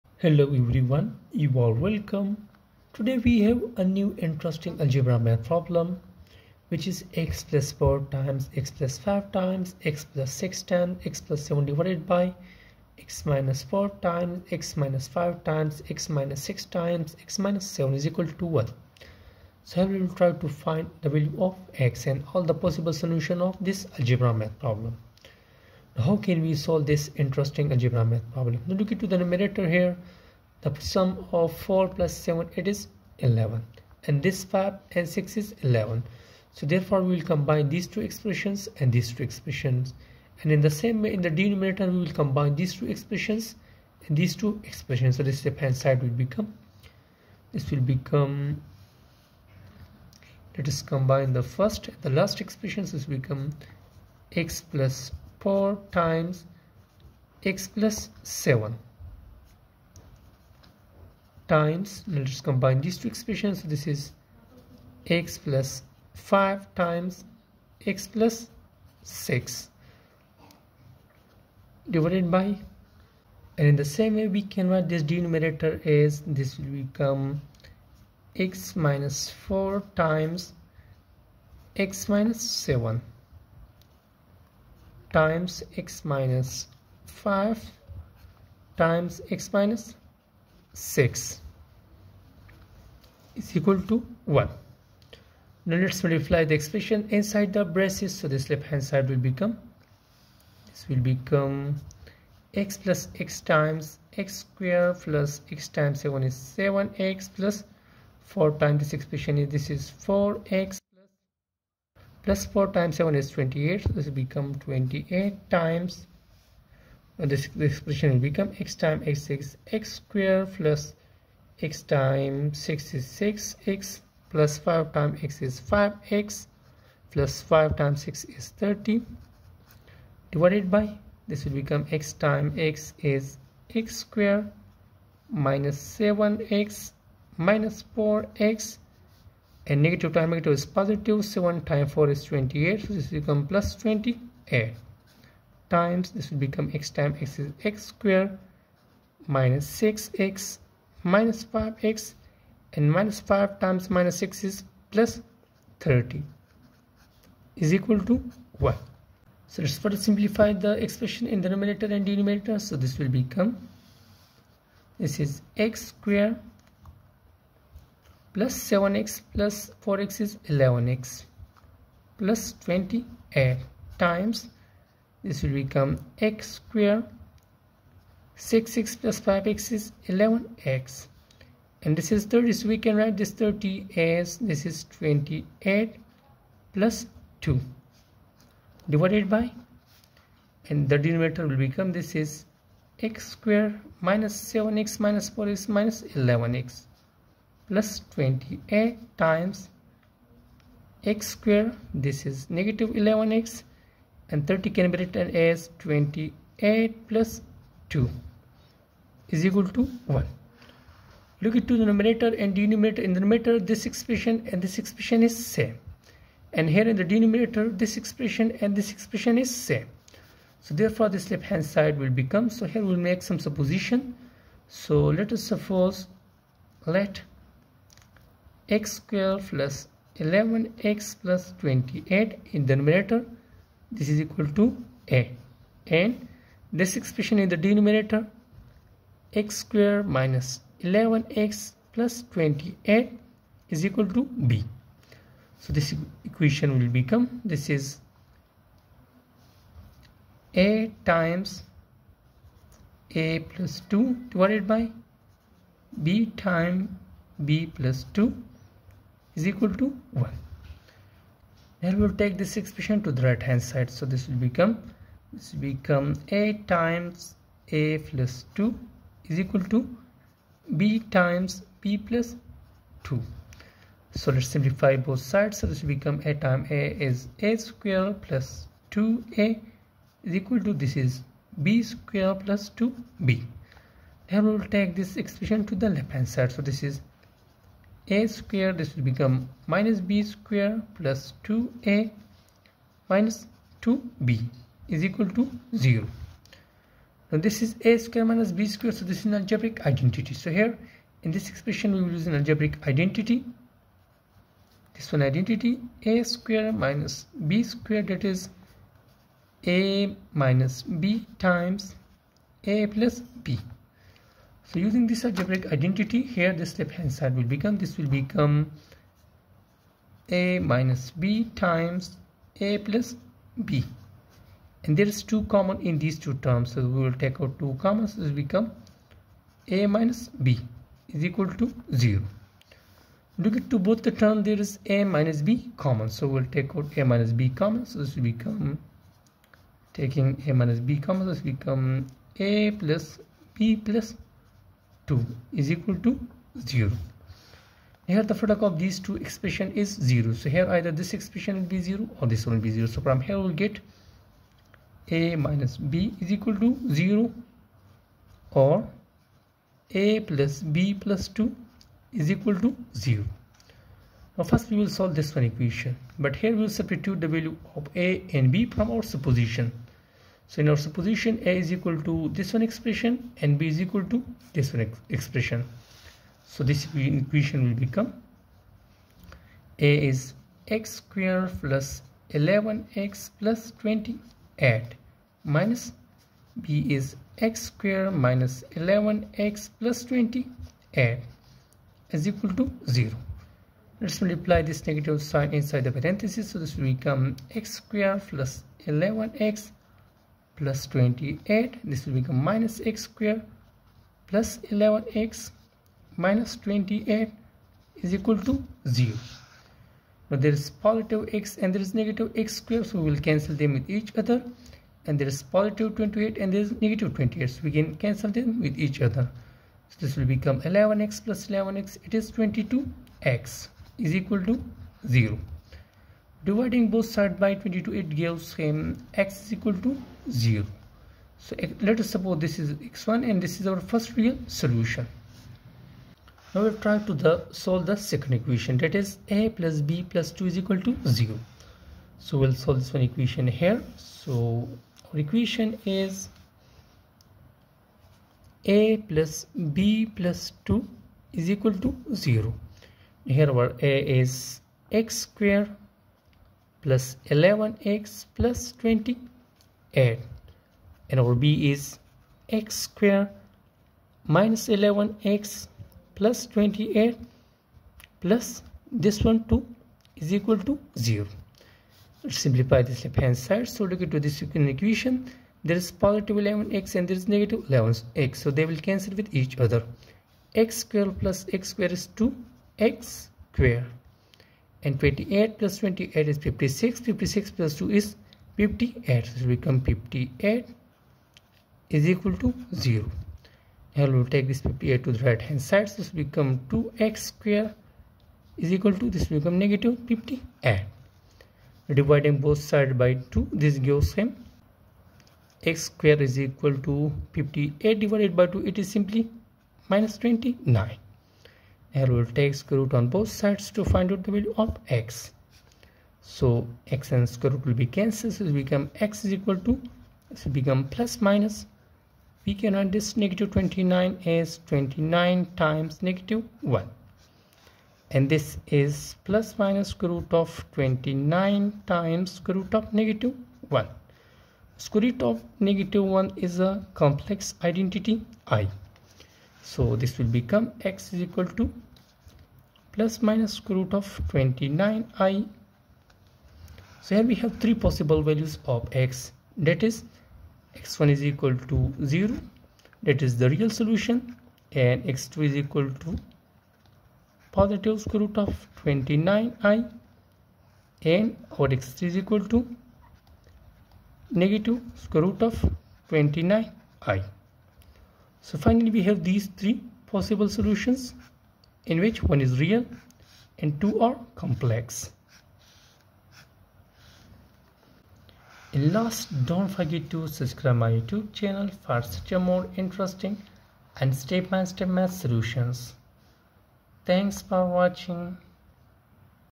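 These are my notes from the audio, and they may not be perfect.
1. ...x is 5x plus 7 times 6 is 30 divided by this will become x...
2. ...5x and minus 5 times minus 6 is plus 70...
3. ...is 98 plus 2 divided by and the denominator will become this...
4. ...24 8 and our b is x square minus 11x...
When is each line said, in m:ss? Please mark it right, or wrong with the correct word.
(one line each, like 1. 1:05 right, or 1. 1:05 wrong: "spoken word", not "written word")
1. 2:05 wrong: "5", not "7"
2. 2:31 wrong: "30", not "70"
3. 3:04 wrong: "28", not "98"
4. 7:38 wrong: "20", not "24".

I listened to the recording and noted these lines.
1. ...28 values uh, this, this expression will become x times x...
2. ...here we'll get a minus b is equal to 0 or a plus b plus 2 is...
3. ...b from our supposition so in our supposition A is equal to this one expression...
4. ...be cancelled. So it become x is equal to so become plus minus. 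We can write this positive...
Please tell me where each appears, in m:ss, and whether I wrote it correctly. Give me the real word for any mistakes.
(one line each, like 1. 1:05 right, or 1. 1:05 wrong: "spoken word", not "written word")
1. 1:54 wrong: "times", not "values"
2. 5:53 right
3. 6:08 right
4. 8:37 wrong: "negative", not "positive".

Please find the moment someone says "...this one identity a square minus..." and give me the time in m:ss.
5:04.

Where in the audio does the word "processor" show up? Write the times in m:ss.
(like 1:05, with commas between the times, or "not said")
not said.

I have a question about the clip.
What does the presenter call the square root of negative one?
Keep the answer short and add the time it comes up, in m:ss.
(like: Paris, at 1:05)
complex identity i, at 8:56.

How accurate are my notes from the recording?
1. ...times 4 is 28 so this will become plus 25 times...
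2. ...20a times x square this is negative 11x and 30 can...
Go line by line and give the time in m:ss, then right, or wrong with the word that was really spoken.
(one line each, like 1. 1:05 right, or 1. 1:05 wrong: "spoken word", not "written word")
1. 2:21 wrong: "28", not "25"
2. 3:18 right.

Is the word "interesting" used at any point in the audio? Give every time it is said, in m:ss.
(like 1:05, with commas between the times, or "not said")
0:04, 0:27, 9:42.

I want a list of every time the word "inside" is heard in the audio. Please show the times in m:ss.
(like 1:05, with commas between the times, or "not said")
1:37, 6:35.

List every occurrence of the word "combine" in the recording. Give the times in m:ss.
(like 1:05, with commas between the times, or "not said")
0:37, 0:42, 0:50, 1:02.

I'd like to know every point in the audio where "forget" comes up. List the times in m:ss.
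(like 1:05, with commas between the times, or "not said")
9:39.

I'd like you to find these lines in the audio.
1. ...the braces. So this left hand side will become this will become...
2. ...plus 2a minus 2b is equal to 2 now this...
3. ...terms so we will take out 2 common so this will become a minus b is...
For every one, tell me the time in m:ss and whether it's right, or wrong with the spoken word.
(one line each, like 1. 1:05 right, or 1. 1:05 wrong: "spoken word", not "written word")
1. 1:37 right
2. 4:50 wrong: "0", not "2"
3. 5:26 right.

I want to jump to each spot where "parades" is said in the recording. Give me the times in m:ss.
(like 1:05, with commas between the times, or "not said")
not said.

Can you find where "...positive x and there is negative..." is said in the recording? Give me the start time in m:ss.
6:50.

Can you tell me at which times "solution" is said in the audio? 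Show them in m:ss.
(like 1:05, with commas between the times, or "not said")
0:22, 7:14, 9:13, 9:30, 9:45.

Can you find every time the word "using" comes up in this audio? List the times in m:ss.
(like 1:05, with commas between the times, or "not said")
5:14.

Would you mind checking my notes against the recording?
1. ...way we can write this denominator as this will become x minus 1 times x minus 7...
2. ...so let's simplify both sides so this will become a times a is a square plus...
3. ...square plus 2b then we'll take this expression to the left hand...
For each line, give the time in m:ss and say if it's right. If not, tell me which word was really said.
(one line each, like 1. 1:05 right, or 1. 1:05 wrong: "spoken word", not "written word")
1. 1:14 wrong: "4", not "1"
2. 4:34 right
3. 4:41 right.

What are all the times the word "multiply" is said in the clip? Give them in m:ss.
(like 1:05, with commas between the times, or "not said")
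1:36, 6:34.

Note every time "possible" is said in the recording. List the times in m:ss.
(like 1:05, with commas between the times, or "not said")
0:22, 9:07, 9:30.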